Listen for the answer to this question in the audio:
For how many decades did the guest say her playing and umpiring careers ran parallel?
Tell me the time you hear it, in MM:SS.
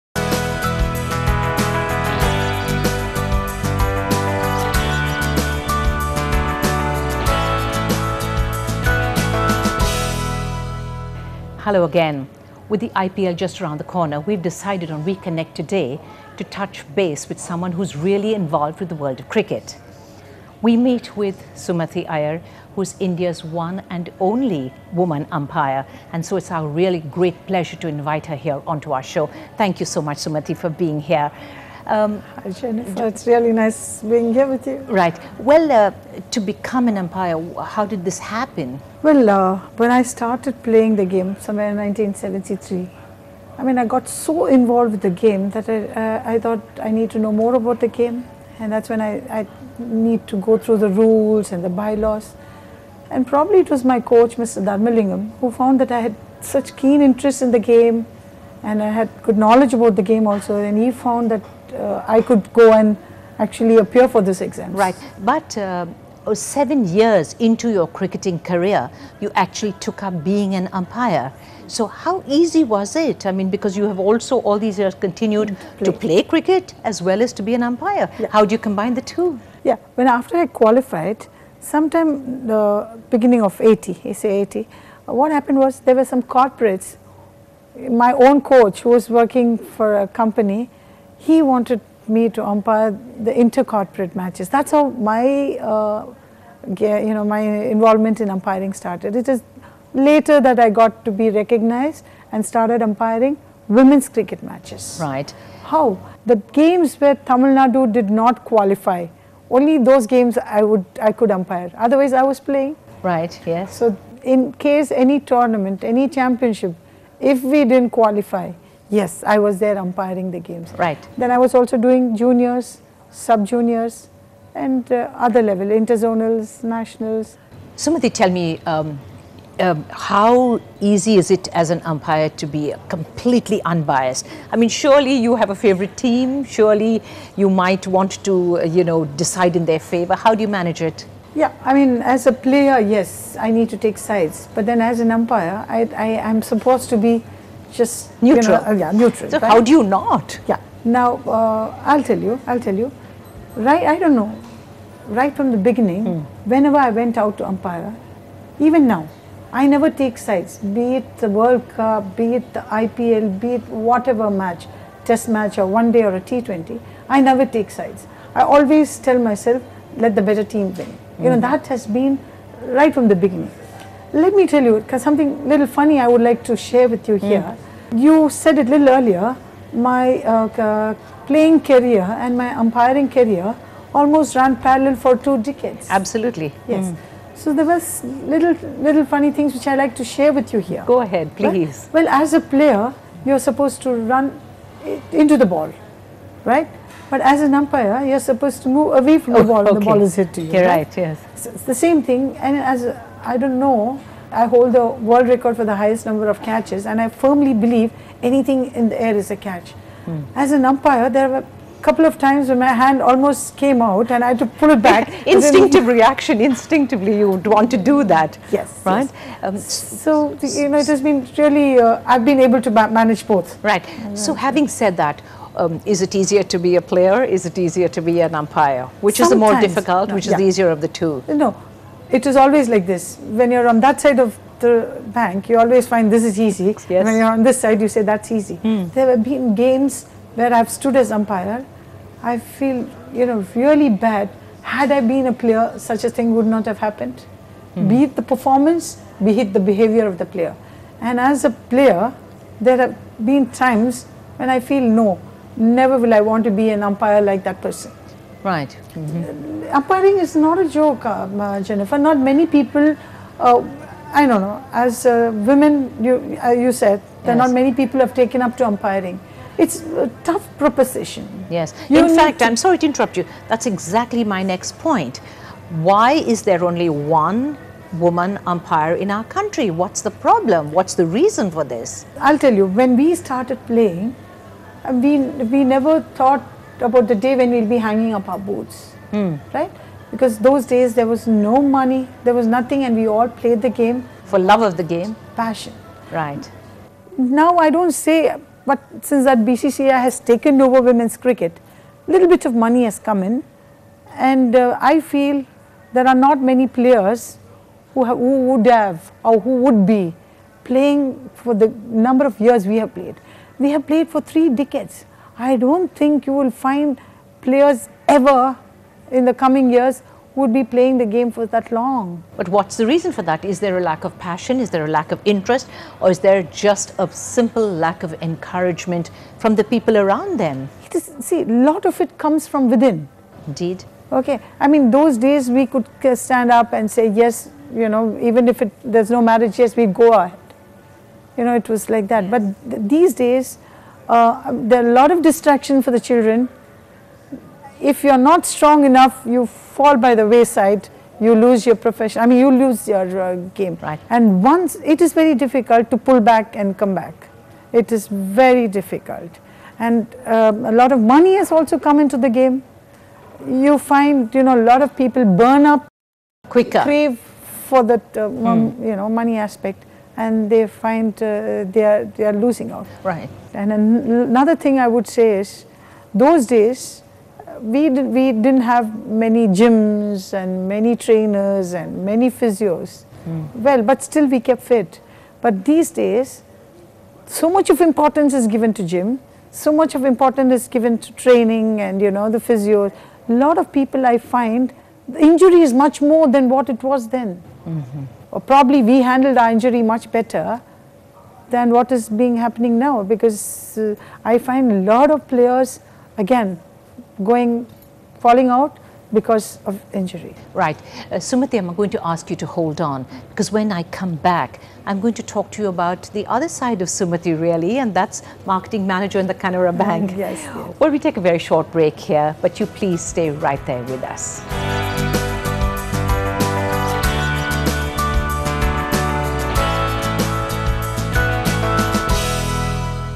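03:05.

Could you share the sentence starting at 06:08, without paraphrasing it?
you know, money aspect and they find uh, they, are, they are losing out.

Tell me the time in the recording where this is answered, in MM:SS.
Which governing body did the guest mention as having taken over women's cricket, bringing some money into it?
04:59.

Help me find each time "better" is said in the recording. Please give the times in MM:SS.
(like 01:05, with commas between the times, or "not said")
02:50, 06:40.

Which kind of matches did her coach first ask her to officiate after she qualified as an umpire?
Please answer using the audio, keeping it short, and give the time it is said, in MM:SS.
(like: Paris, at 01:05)
Intercorporate matches, at 01:33.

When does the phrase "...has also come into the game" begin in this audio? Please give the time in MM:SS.
06:01.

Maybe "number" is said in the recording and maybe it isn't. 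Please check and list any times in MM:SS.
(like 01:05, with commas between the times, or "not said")
03:26, 05:11.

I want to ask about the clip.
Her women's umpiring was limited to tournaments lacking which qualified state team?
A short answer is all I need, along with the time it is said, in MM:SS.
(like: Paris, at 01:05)
Tamil Nadu, at 01:47.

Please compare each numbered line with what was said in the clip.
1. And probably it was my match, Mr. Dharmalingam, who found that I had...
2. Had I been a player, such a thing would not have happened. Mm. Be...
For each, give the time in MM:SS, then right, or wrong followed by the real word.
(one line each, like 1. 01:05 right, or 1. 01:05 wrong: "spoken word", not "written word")
1. 00:53 wrong: "coach", not "match"
2. 04:04 right.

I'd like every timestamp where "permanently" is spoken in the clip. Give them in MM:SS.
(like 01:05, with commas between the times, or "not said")
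not said.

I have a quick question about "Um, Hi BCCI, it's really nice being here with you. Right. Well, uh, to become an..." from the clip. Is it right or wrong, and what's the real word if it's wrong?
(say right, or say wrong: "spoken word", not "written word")
wrong: "Jeniffer", not "BCCI".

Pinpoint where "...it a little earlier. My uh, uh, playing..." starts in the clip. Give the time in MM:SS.
02:58.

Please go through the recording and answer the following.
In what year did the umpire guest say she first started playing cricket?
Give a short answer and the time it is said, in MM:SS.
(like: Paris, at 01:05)
1973, at 00:41.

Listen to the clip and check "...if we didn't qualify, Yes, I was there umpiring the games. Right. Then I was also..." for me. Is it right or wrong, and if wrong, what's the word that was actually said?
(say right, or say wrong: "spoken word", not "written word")
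right.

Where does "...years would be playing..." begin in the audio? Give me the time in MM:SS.
05:19.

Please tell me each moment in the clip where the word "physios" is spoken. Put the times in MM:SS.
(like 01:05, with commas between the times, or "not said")
06:22, 06:32.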